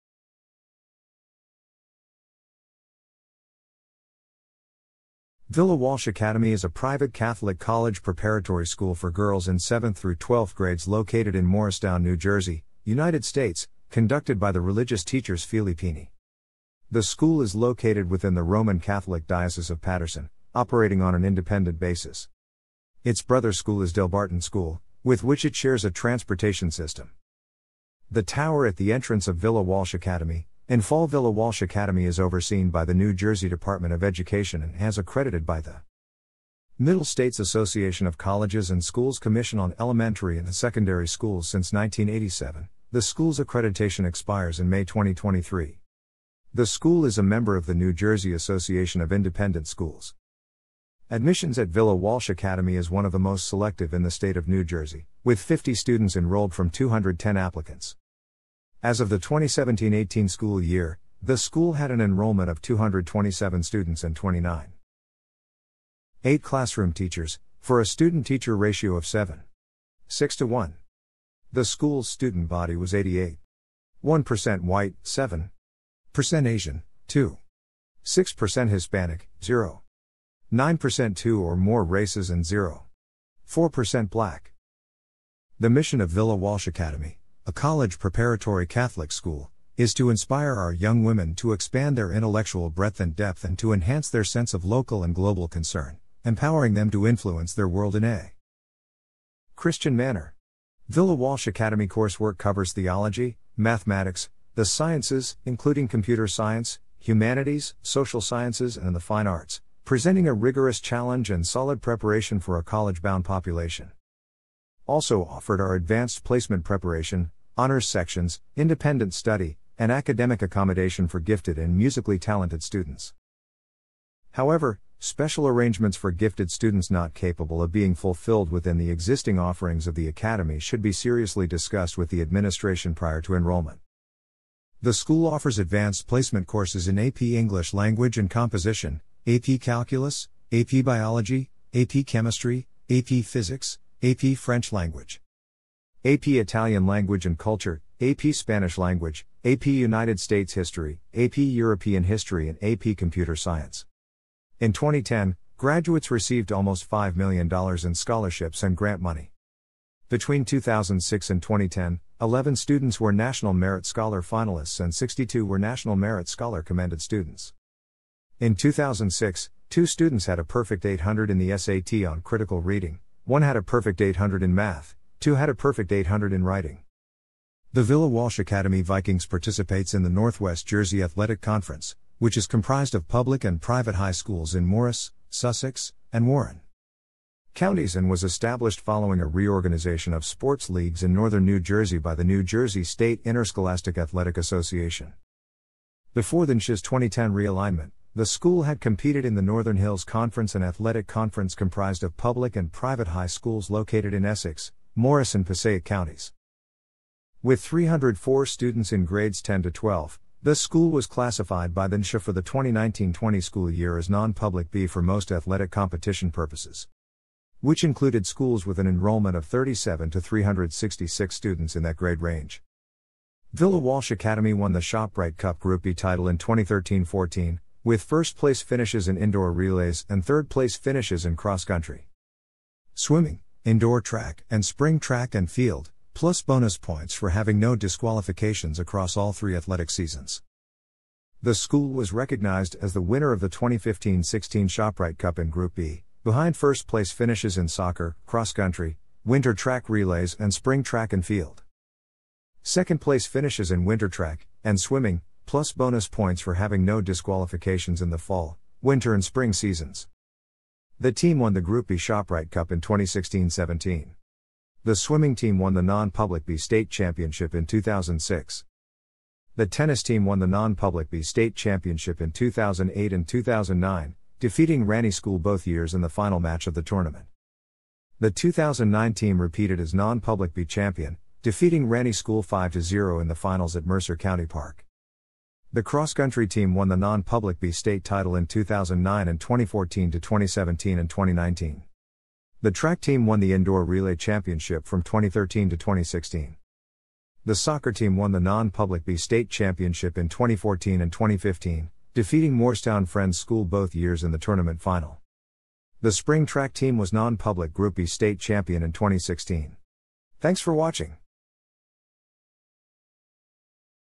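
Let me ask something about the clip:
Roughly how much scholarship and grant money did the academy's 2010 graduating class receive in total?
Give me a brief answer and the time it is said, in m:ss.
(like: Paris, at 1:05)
almost $5 million, at 2:36.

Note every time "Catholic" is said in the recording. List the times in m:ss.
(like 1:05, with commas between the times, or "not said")
0:07, 0:18, 1:28.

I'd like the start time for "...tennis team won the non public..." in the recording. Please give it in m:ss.
4:29.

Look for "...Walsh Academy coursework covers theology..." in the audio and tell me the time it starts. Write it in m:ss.
1:41.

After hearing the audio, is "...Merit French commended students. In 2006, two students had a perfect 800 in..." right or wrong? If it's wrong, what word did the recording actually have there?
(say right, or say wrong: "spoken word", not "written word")
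wrong: "Scholar", not "French".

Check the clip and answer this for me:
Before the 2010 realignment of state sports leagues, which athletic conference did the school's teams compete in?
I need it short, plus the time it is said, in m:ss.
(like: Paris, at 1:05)
Northern Hills Conference, at 3:19.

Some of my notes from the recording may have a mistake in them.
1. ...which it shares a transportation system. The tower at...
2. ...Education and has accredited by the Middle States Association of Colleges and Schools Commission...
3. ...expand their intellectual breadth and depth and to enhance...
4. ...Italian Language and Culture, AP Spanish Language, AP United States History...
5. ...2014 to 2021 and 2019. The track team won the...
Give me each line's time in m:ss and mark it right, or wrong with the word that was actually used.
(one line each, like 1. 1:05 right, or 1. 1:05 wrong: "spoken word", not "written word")
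1. 0:25 right
2. 0:34 right
3. 1:31 right
4. 2:26 right
5. 4:49 wrong: "2017", not "2021".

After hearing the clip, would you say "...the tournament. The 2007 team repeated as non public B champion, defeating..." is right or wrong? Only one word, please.
wrong.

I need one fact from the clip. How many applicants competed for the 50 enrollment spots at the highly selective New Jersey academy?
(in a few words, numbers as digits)
210.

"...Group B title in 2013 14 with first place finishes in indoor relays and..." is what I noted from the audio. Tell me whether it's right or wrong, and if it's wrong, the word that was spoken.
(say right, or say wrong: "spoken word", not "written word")
right.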